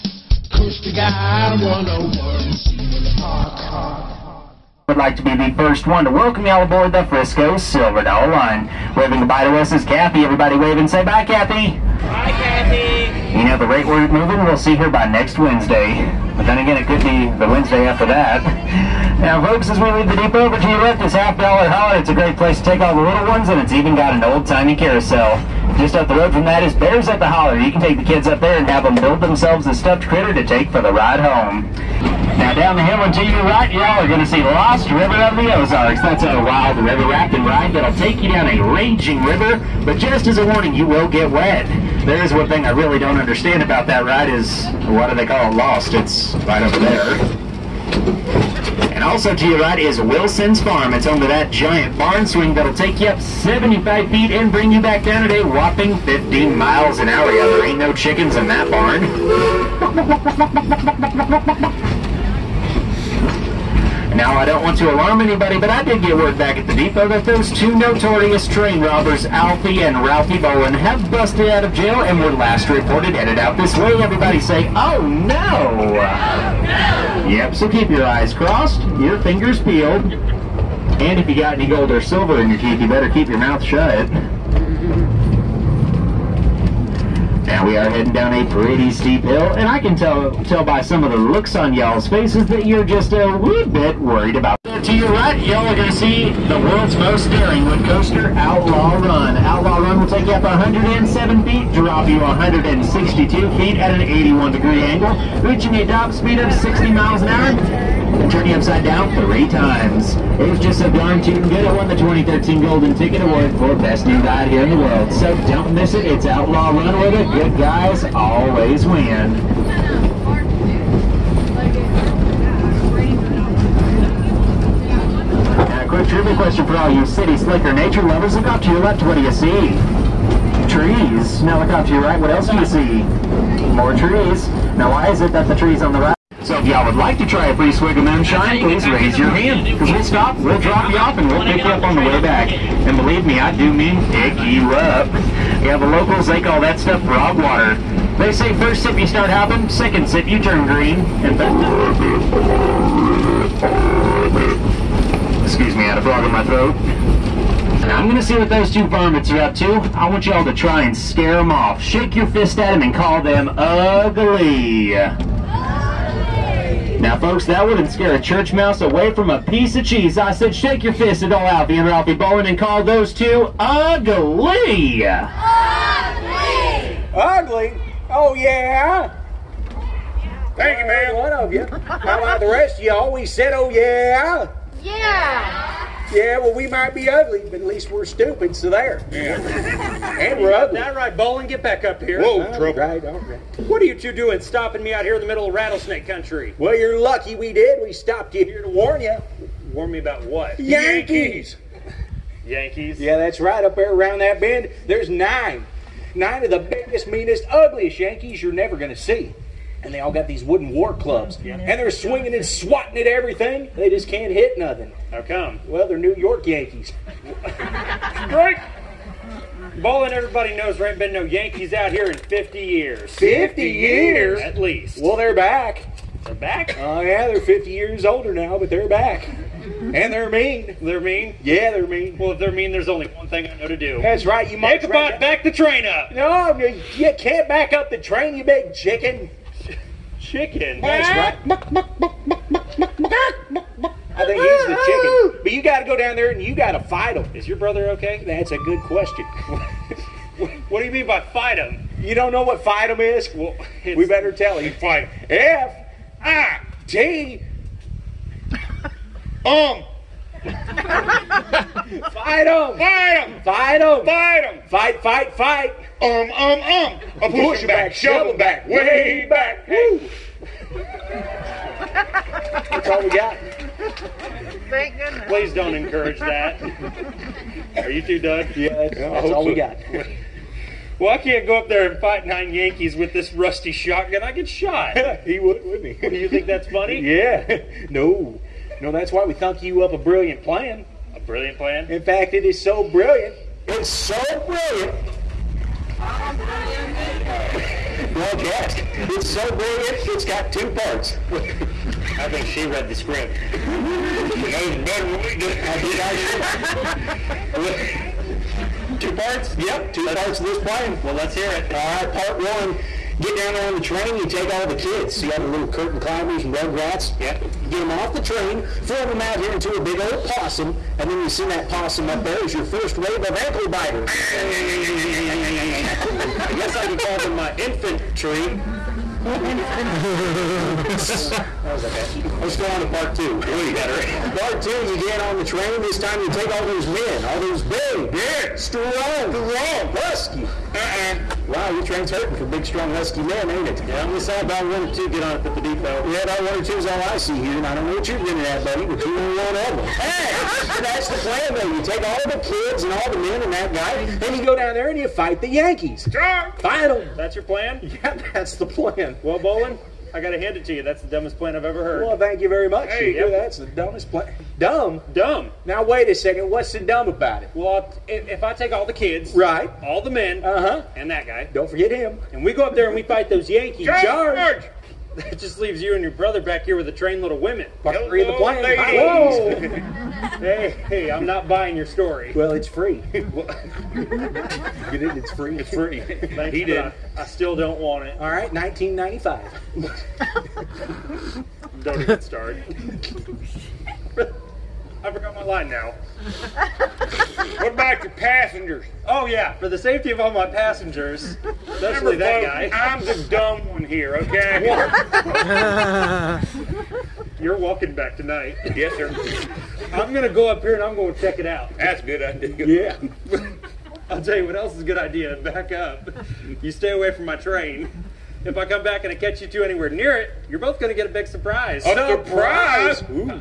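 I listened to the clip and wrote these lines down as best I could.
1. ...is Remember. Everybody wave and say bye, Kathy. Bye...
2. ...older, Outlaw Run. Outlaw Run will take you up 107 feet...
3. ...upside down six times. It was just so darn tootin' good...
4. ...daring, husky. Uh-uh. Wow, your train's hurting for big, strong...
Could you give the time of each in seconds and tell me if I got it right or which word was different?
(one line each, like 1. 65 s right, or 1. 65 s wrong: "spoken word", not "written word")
1. 9 s wrong: "Kathy", not "Remember"
2. 97 s wrong: "coaster", not "older"
3. 108 s wrong: "three", not "six"
4. 339 s wrong: "strong", not "daring".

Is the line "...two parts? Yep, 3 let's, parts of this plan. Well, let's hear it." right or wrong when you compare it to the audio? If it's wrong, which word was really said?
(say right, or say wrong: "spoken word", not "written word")
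wrong: "2", not "3".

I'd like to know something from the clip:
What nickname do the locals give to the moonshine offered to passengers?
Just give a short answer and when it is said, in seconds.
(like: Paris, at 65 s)
Frog water, at 147 s.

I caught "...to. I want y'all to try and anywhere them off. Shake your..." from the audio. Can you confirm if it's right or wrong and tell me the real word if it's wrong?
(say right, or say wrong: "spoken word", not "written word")
wrong: "scare", not "anywhere".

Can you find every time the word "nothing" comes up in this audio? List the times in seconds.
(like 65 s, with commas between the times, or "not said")
214 s.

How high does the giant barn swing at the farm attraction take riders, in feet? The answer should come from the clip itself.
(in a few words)
75 feet.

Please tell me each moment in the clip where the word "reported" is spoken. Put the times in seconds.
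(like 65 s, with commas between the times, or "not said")
72 s.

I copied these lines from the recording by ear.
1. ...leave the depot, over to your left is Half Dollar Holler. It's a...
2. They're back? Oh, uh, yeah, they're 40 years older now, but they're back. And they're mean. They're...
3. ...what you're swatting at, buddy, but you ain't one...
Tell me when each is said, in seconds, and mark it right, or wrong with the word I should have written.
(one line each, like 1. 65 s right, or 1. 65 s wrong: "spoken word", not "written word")
1. 19 s right
2. 226 s wrong: "50", not "40"
3. 347 s wrong: "grinning", not "swatting".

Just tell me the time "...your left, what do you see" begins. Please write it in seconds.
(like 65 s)
128 s.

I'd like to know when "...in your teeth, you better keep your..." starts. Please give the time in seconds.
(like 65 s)
82 s.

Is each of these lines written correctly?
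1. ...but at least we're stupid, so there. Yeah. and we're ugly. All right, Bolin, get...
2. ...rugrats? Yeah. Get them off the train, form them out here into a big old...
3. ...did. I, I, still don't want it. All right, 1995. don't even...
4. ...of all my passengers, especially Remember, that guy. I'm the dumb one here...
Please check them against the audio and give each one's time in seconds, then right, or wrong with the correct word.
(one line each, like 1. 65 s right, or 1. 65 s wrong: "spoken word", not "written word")
1. 187 s right
2. 316 s right
3. 386 s right
4. 400 s right.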